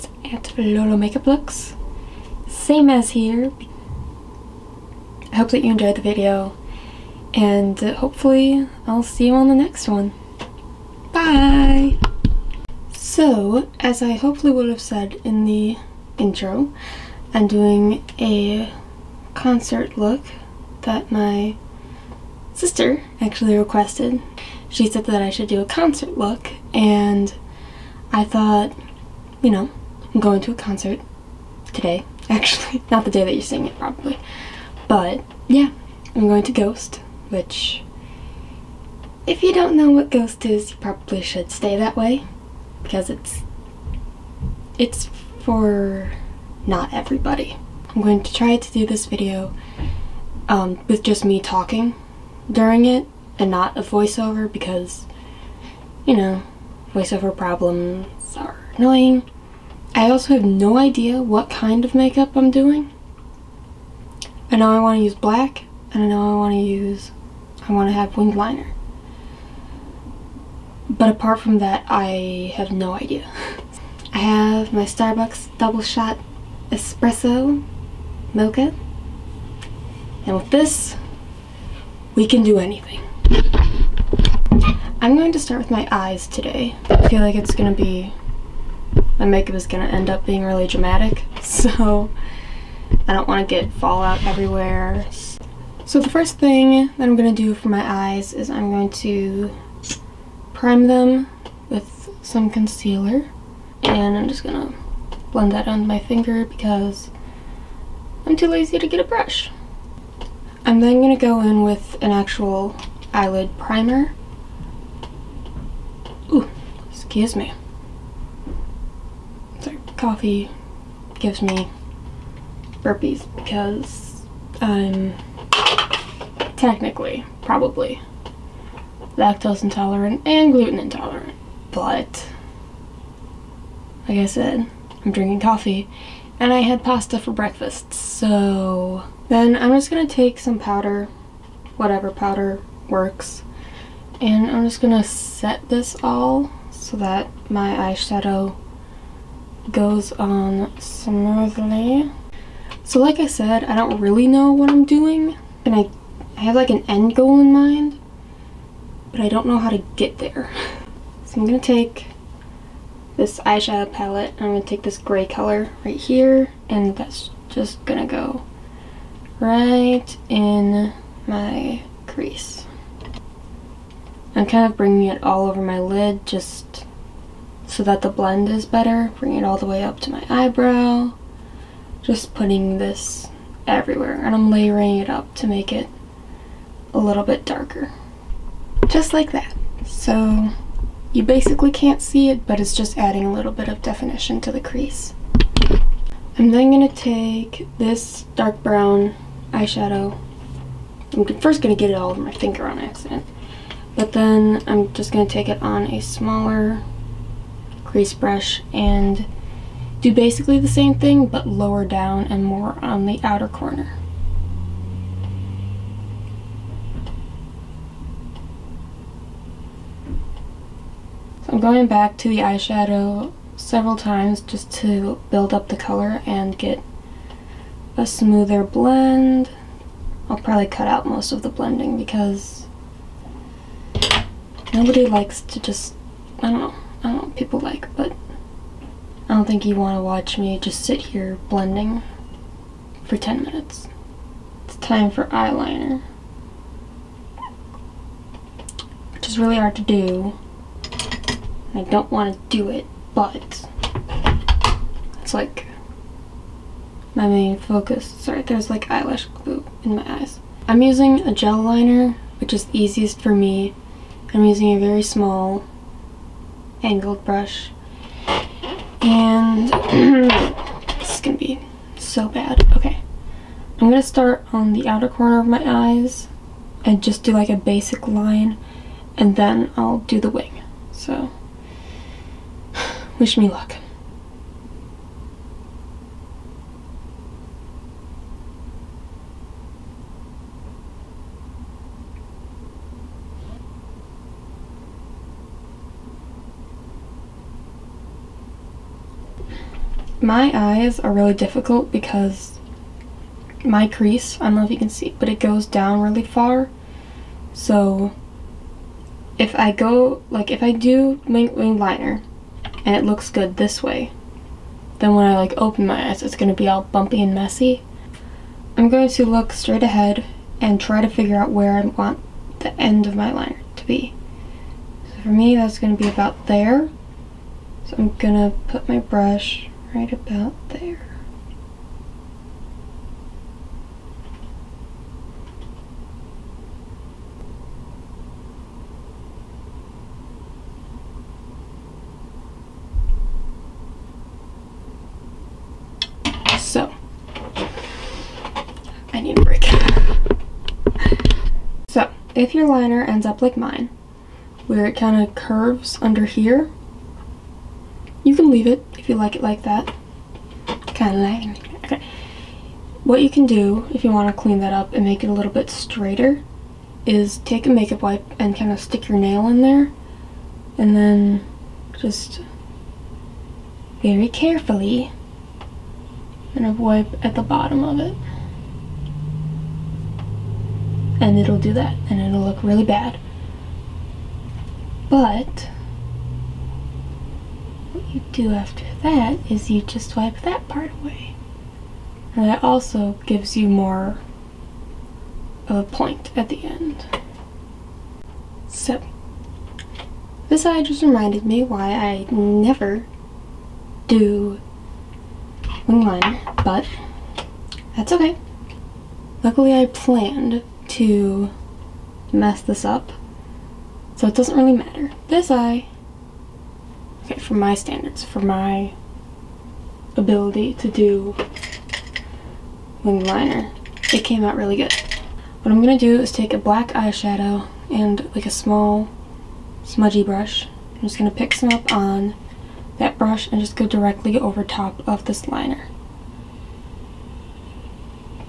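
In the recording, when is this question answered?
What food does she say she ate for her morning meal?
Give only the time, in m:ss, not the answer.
2:16.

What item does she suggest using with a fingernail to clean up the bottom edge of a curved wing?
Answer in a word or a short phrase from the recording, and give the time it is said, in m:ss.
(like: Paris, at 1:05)
makeup wipe, at 6:07.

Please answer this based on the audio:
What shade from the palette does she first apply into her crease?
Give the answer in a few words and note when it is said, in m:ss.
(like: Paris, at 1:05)
gray, at 2:44.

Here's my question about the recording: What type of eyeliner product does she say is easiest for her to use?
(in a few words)
gel liner.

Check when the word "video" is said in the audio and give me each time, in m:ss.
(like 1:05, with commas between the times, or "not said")
0:06, 0:49.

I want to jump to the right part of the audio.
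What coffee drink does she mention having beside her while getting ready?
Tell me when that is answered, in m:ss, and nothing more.
1:14.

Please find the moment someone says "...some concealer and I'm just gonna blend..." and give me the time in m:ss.
1:42.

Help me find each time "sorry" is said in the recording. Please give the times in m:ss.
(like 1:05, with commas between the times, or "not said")
1:59, 4:18.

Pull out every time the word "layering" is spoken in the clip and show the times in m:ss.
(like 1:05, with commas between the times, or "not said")
3:04.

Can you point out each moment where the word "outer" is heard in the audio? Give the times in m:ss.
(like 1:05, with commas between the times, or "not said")
3:33, 4:34.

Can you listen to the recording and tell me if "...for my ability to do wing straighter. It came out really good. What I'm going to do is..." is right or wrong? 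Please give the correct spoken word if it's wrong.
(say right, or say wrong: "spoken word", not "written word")
wrong: "liner", not "straighter".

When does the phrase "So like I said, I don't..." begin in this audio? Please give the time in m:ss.
2:32.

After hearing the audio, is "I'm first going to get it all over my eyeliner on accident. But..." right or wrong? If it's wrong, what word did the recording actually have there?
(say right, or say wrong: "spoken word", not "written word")
wrong: "finger", not "eyeliner".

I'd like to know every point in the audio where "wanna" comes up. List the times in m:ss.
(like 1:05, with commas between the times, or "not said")
1:33.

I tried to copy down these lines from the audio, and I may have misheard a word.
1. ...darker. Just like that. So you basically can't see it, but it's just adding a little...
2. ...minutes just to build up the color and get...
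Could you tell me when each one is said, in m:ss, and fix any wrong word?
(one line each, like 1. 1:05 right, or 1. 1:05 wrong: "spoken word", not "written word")
1. 3:07 right
2. 3:43 wrong: "times", not "minutes".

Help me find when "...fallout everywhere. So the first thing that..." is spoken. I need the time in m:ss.
1:33.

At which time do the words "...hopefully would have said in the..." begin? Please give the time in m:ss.
0:14.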